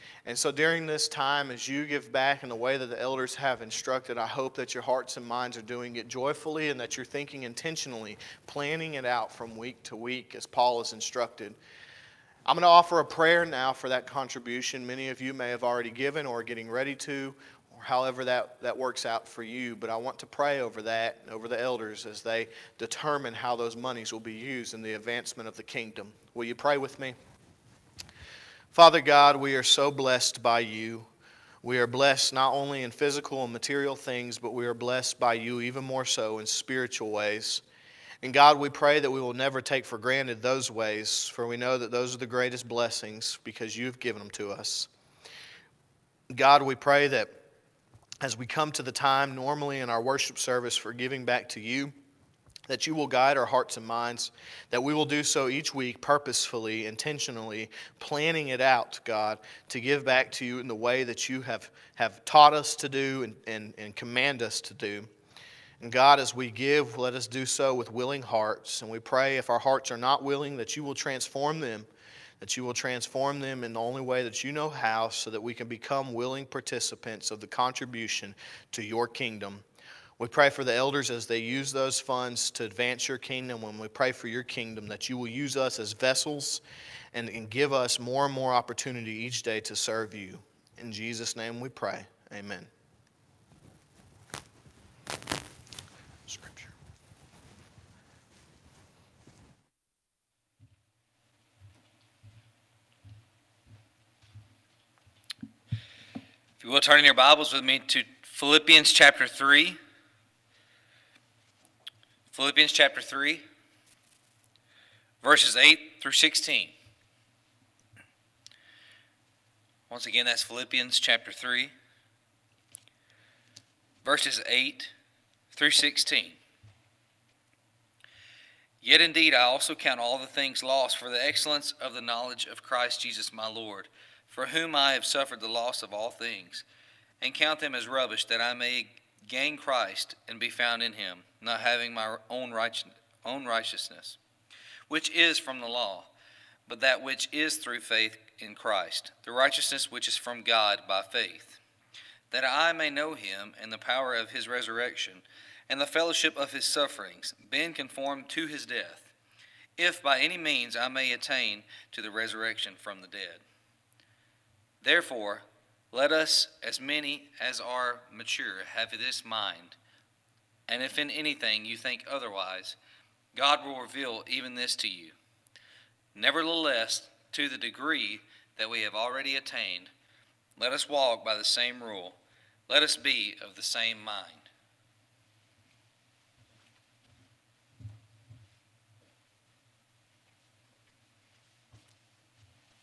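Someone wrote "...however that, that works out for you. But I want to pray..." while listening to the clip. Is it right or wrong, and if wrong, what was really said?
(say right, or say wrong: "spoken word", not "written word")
right.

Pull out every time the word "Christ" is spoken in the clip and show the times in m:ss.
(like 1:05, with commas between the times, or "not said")
2:12, 2:19, 2:28.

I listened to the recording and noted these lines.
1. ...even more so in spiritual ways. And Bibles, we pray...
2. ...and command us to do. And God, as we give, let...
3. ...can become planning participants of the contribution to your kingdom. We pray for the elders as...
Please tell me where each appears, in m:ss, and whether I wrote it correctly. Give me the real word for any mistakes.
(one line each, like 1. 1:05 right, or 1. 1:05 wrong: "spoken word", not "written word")
1. 0:35 wrong: "God", not "Bibles"
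2. 1:03 right
3. 1:15 wrong: "willing", not "planning".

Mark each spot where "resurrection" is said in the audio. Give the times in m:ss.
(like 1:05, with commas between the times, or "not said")
2:34, 2:42.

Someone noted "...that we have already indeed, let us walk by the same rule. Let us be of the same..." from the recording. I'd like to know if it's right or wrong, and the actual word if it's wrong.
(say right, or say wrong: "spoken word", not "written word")
wrong: "attained", not "indeed".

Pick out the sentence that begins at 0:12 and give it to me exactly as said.
I'm going to offer a prayer now for that contribution.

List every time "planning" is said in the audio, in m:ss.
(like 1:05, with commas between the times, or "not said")
0:08, 0:57.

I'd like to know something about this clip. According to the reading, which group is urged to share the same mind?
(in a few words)
as many as are mature.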